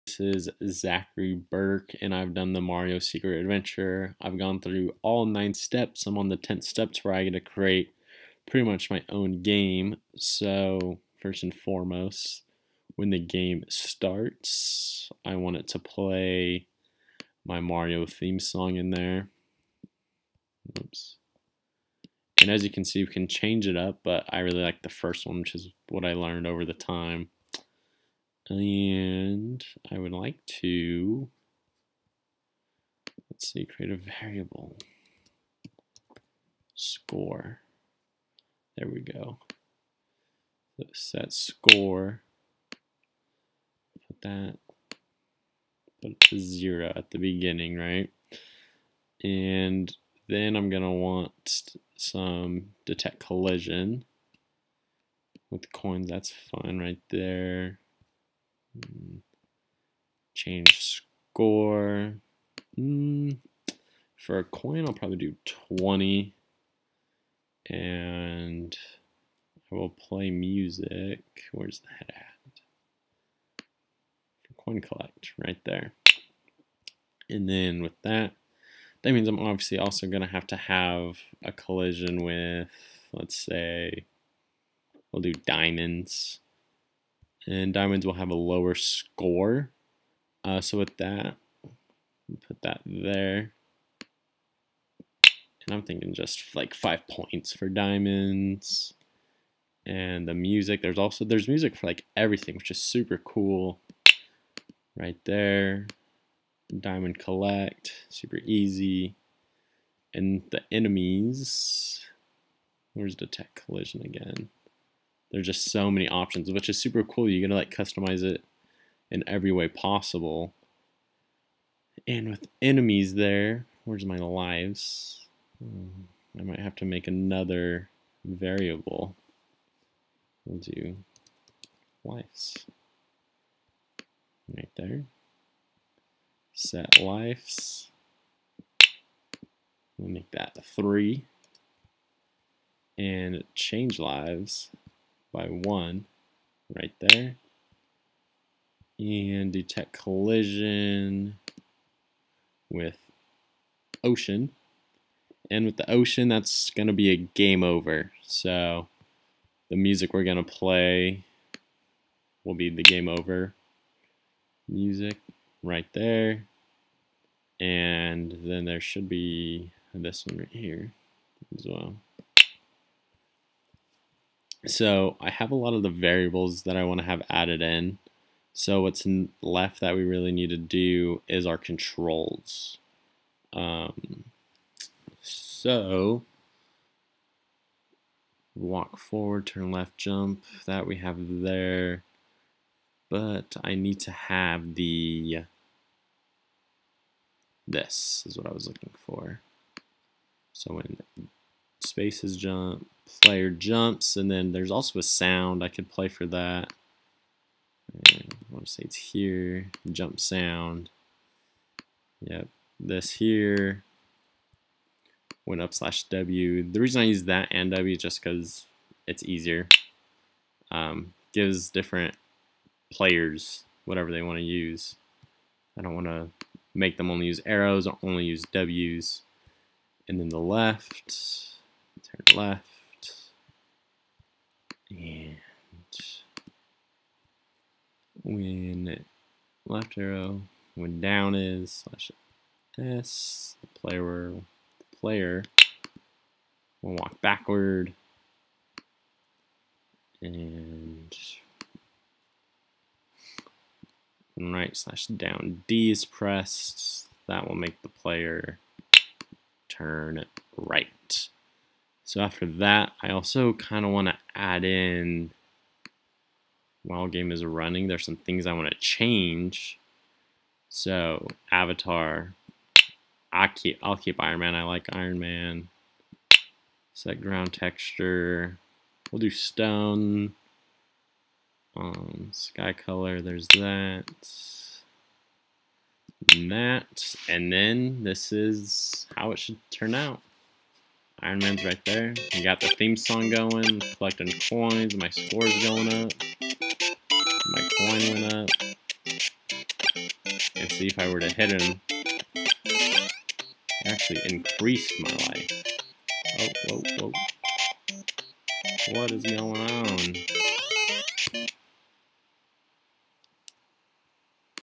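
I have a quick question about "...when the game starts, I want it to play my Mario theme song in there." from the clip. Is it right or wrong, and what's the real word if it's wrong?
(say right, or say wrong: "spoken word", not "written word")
right.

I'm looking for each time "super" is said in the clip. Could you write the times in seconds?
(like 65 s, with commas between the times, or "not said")
102 s, 108 s, 116 s.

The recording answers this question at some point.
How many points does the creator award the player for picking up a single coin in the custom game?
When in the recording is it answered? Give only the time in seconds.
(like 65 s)
65 s.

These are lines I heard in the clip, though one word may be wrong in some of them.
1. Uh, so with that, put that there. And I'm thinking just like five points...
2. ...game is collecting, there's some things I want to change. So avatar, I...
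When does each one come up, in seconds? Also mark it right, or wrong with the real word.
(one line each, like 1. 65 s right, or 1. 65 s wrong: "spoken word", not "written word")
1. 90 s right
2. 267 s wrong: "running", not "collecting".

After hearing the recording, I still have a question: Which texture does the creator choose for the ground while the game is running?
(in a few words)
Stone.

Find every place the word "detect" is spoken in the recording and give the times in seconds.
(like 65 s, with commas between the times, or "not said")
52 s, 113 s, 149 s.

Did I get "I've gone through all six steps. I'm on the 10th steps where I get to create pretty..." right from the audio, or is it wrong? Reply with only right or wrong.
wrong.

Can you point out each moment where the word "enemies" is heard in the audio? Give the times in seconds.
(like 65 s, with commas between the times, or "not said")
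110 s, 122 s.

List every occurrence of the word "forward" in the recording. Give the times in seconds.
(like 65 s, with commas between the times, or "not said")
188 s.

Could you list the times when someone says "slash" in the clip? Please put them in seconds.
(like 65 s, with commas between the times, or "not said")
215 s, 241 s, 254 s.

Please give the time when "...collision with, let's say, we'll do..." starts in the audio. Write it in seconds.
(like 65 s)
81 s.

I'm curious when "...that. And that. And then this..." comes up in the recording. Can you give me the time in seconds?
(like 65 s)
283 s.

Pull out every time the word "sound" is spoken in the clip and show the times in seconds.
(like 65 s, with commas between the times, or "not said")
205 s, 210 s.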